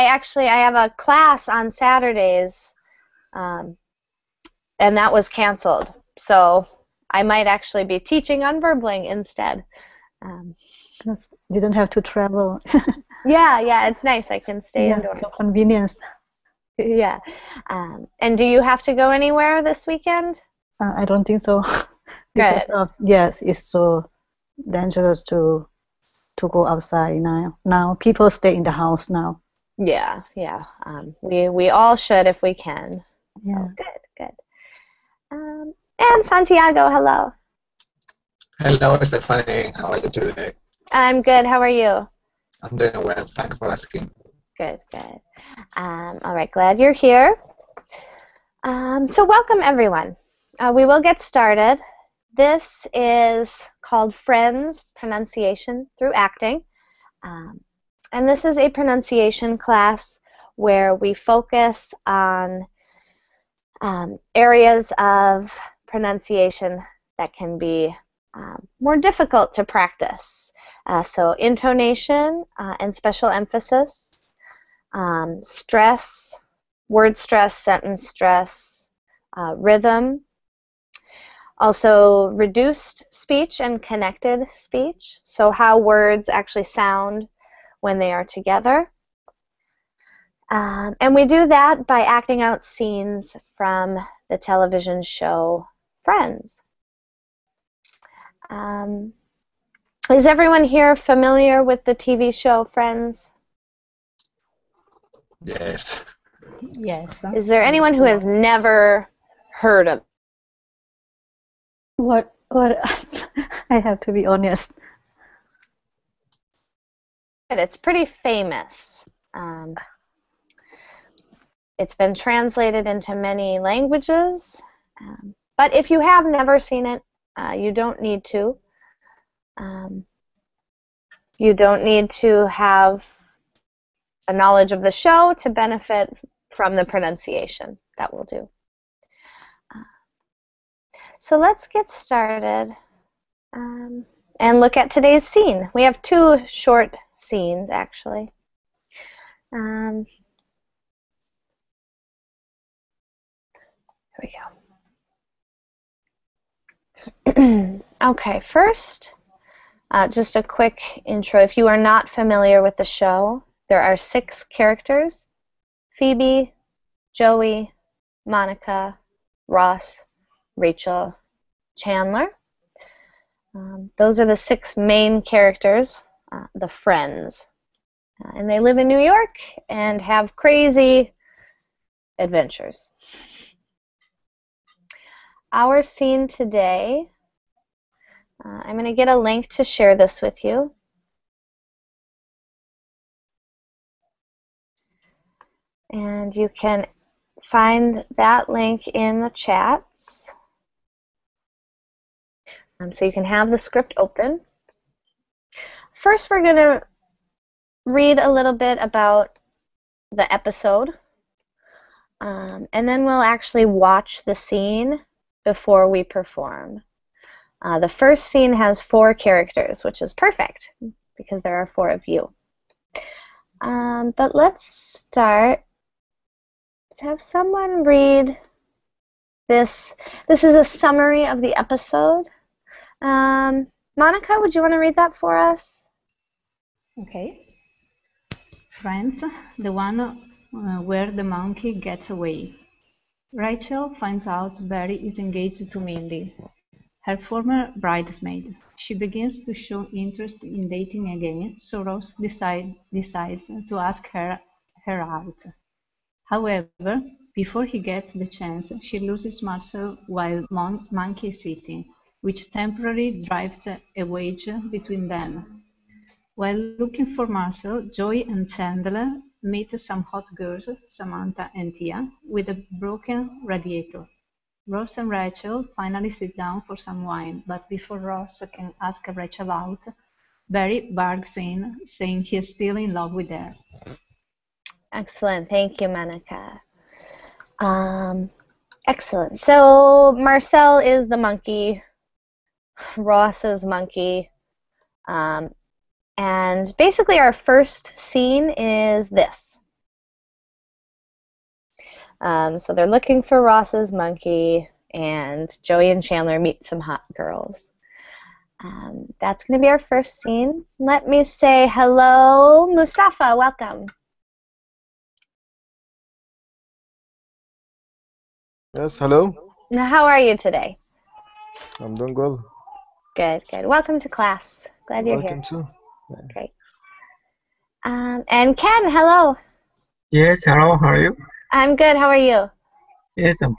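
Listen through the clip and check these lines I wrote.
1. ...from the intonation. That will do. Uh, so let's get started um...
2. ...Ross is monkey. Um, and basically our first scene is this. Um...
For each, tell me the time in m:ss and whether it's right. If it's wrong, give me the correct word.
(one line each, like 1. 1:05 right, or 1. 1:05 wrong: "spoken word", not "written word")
1. 2:16 wrong: "pronunciation", not "intonation"
2. 4:52 right.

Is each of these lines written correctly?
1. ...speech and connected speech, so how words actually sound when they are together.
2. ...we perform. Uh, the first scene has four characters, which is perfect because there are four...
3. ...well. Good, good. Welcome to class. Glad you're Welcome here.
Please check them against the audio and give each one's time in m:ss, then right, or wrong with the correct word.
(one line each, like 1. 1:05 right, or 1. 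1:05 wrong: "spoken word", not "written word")
1. 1:23 right
2. 3:35 right
3. 5:22 right.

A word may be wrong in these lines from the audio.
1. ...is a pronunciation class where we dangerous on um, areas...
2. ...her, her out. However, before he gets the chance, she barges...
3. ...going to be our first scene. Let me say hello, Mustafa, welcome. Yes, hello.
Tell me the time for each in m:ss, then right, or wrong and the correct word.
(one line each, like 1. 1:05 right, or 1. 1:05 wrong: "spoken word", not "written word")
1. 0:58 wrong: "focus", not "dangerous"
2. 4:14 wrong: "loses", not "barges"
3. 5:09 right.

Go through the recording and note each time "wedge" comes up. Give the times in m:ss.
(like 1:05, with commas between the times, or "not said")
4:24.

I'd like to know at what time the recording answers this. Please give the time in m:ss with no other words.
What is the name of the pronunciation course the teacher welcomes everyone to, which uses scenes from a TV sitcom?
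0:54.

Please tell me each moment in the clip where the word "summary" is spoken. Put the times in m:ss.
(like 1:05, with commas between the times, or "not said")
3:50.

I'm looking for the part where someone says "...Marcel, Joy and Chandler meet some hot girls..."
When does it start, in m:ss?
4:27.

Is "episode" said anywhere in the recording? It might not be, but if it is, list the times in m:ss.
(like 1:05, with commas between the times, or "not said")
3:30, 3:51.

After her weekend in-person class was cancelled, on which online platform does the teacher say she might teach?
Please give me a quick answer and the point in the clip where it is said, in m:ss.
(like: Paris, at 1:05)
Verbling, at 0:08.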